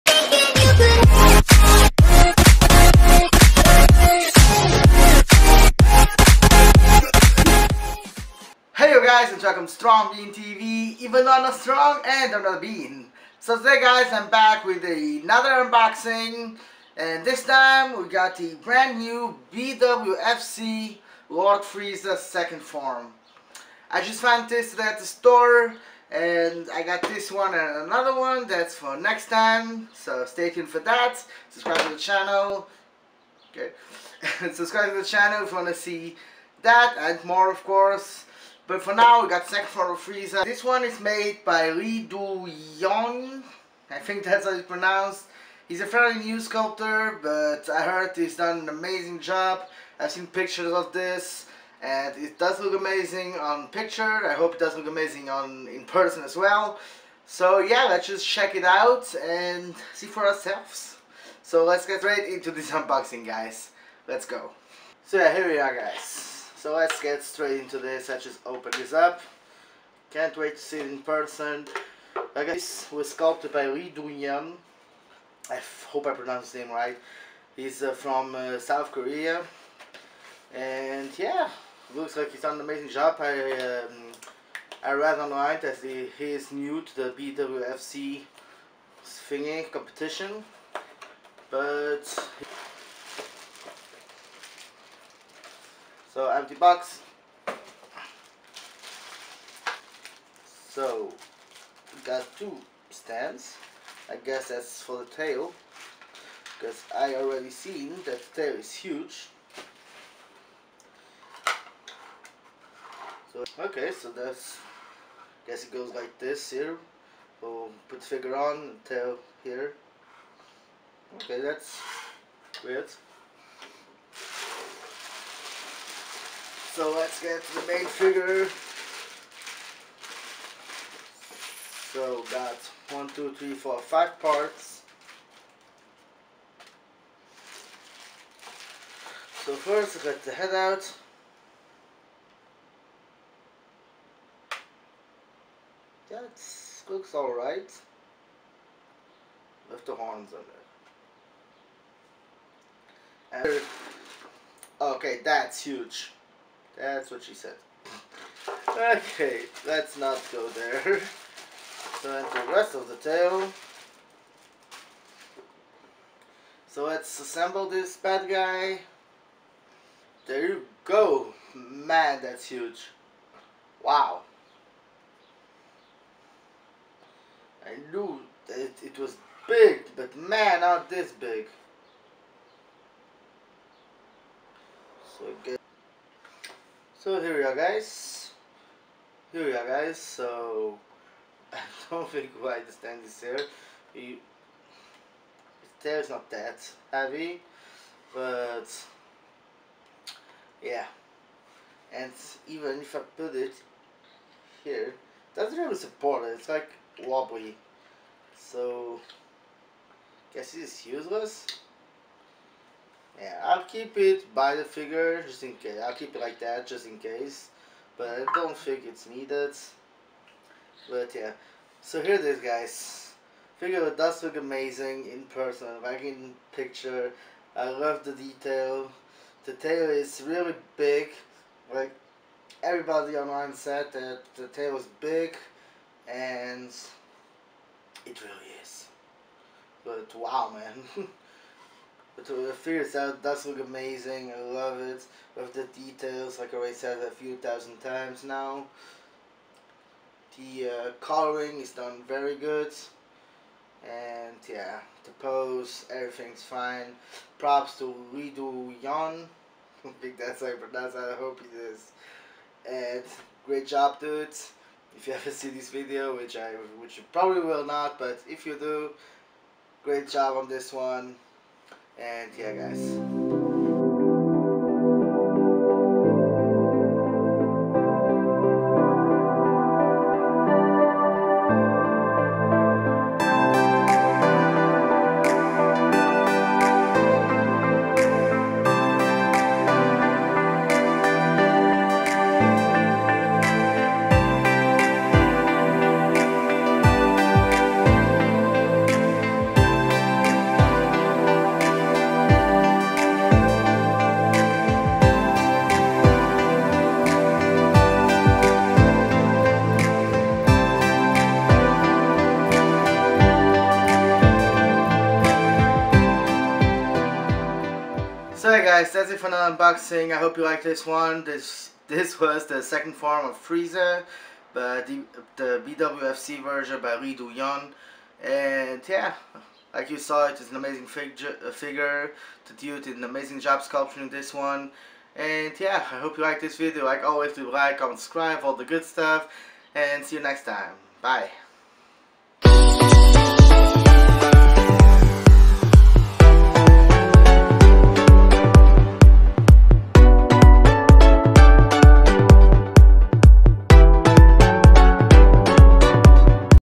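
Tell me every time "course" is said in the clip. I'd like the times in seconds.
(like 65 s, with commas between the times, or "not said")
37 s.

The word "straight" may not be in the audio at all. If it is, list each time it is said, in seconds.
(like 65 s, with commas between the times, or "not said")
67 s.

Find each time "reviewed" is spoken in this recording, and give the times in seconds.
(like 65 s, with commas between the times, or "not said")
not said.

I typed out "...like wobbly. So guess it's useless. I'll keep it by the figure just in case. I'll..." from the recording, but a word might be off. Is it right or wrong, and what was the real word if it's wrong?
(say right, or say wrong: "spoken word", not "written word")
right.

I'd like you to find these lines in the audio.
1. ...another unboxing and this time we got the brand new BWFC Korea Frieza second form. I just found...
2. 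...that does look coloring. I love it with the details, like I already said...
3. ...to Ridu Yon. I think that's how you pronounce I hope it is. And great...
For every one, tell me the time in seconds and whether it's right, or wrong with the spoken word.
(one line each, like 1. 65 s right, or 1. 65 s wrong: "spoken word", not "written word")
1. 14 s wrong: "Lord", not "Korea"
2. 242 s wrong: "amazing", not "coloring"
3. 257 s right.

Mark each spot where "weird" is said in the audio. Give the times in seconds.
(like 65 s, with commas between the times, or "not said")
122 s.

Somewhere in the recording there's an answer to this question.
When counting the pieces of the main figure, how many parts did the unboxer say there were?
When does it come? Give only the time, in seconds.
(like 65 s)
133 s.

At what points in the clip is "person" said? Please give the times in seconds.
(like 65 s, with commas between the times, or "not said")
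55 s, 70 s, 225 s.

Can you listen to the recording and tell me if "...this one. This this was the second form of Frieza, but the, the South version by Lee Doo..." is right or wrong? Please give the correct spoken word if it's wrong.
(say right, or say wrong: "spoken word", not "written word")
wrong: "BWFC", not "South".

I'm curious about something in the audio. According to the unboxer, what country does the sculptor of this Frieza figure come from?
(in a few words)
South Korea.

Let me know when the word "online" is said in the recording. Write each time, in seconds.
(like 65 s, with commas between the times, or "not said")
85 s, 233 s.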